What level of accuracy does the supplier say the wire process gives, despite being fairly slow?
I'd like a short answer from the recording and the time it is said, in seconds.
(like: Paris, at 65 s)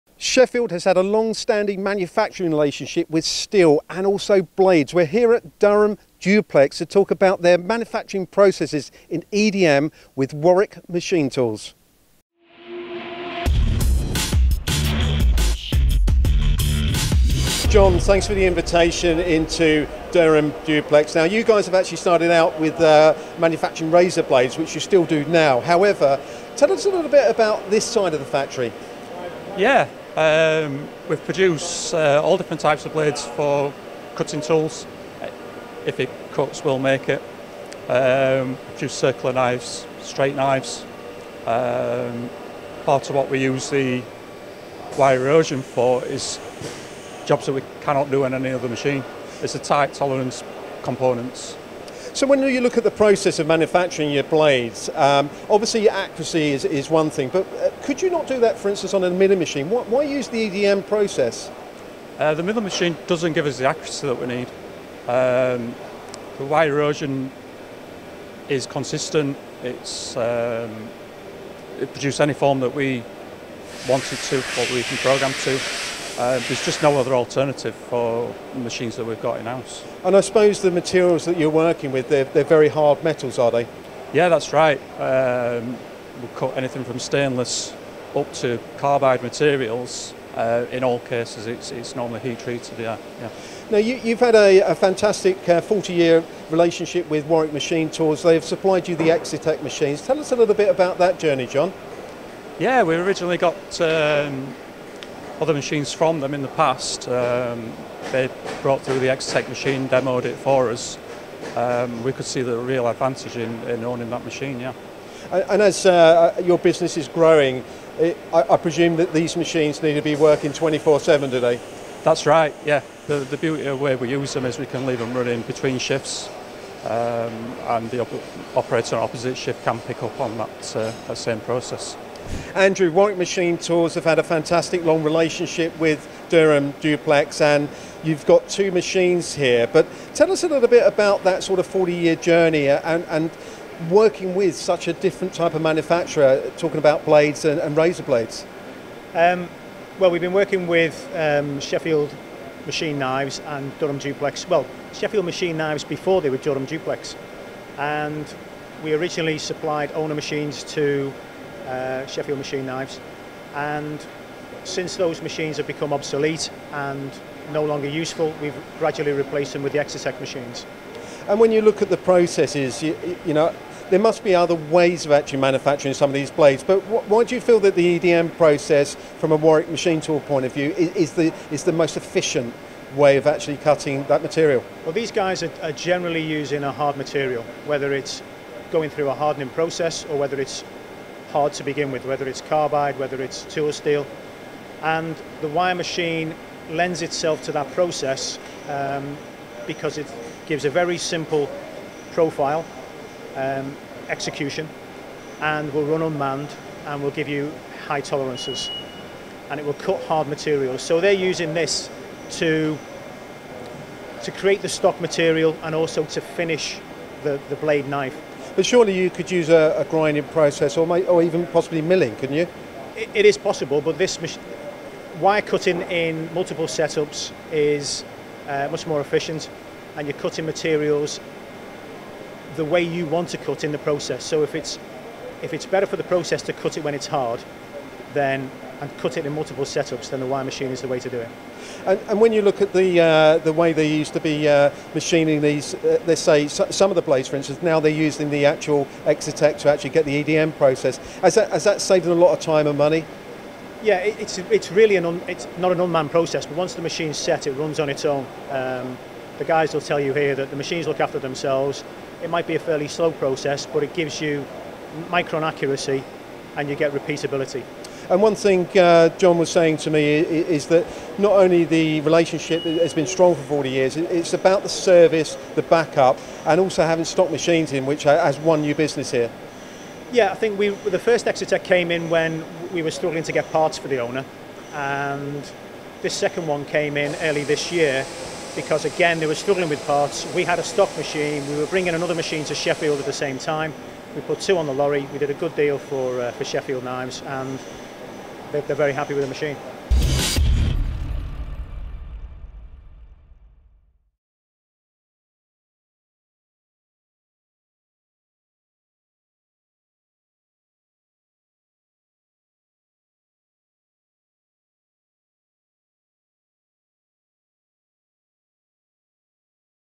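Micron accuracy, at 265 s.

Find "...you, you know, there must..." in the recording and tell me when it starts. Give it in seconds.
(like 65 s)
172 s.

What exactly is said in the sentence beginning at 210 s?
So they're using this to, to create the stock material and also to finish the, the blade knife.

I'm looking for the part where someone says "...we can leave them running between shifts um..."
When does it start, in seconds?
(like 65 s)
124 s.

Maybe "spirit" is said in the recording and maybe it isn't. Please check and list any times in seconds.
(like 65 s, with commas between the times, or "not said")
not said.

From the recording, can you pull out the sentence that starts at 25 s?
However, tell us a little bit about this side of the factory.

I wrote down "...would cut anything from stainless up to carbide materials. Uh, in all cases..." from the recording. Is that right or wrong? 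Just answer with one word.
right.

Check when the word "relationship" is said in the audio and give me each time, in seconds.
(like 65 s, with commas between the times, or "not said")
2 s, 96 s, 135 s, 272 s.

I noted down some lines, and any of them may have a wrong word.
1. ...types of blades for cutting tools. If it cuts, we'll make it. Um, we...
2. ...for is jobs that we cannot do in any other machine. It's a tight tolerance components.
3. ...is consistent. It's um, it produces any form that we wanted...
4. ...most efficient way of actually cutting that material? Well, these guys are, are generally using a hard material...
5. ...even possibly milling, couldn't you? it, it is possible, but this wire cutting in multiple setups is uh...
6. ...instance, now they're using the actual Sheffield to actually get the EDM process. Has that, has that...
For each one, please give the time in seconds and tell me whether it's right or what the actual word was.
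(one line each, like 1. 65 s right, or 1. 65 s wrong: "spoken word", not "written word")
1. 32 s right
2. 45 s right
3. 68 s right
4. 181 s right
5. 221 s right
6. 247 s wrong: "Excetek", not "Sheffield".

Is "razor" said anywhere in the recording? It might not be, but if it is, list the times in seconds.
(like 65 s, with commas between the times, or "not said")
23 s, 147 s.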